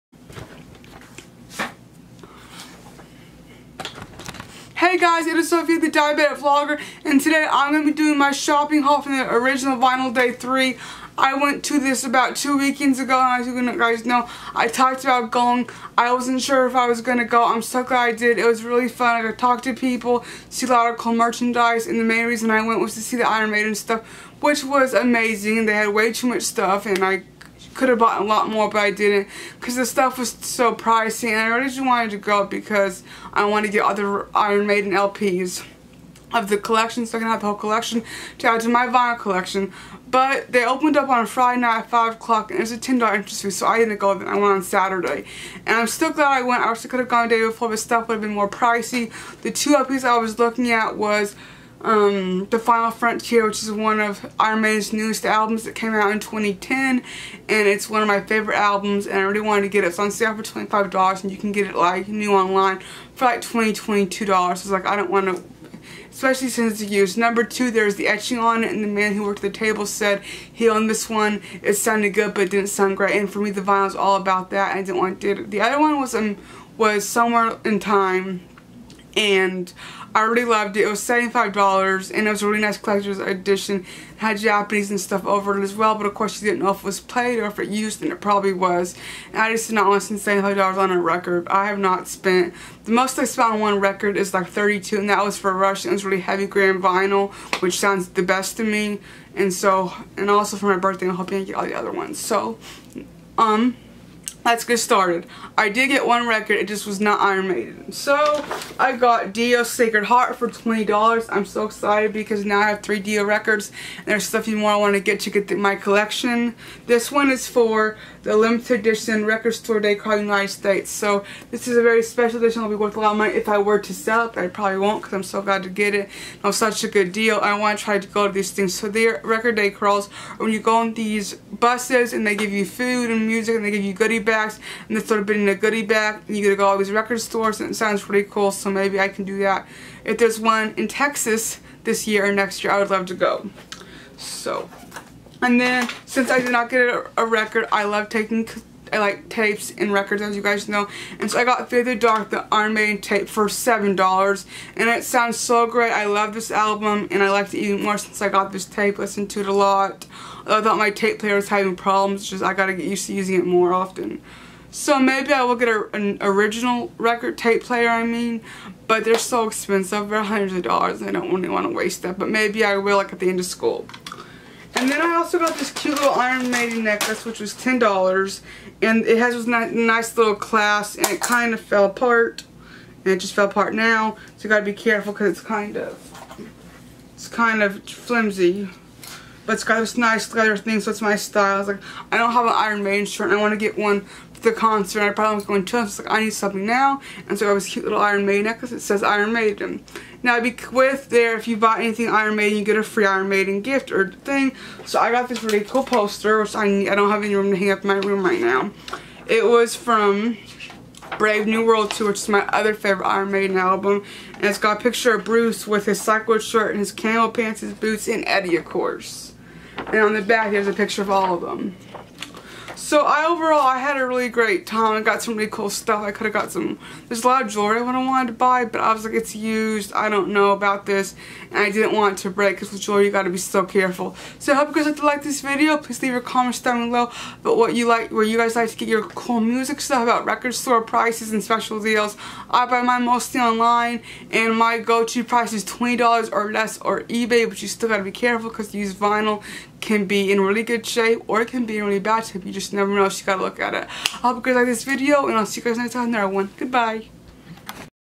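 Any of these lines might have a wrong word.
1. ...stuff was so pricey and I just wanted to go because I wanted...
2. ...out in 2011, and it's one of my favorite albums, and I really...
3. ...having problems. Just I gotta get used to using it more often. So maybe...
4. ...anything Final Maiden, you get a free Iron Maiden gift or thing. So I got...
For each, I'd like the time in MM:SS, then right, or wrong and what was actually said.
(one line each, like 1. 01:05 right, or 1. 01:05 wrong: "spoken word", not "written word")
1. 00:29 right
2. 00:55 wrong: "2010", not "2011"
3. 02:41 right
4. 03:21 wrong: "Iron", not "Final".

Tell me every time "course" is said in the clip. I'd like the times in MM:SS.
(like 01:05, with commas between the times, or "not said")
01:26, 03:38.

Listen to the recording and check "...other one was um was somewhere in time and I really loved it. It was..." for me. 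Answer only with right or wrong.
right.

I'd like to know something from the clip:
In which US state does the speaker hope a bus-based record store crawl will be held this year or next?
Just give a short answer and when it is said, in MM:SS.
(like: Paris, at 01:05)
Texas, at 02:20.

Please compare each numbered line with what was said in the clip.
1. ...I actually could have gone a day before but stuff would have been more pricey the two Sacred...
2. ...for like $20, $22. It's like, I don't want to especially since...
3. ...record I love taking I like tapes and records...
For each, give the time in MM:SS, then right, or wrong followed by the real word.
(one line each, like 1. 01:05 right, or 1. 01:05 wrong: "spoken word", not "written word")
1. 00:46 wrong: "LPs", not "Sacred"
2. 01:03 right
3. 02:27 right.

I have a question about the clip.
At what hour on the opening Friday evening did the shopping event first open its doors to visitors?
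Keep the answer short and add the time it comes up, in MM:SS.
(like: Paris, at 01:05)
5 o'clock, at 00:41.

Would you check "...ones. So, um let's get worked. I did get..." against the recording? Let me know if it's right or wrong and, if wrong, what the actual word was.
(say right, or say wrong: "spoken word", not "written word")
wrong: "started", not "worked".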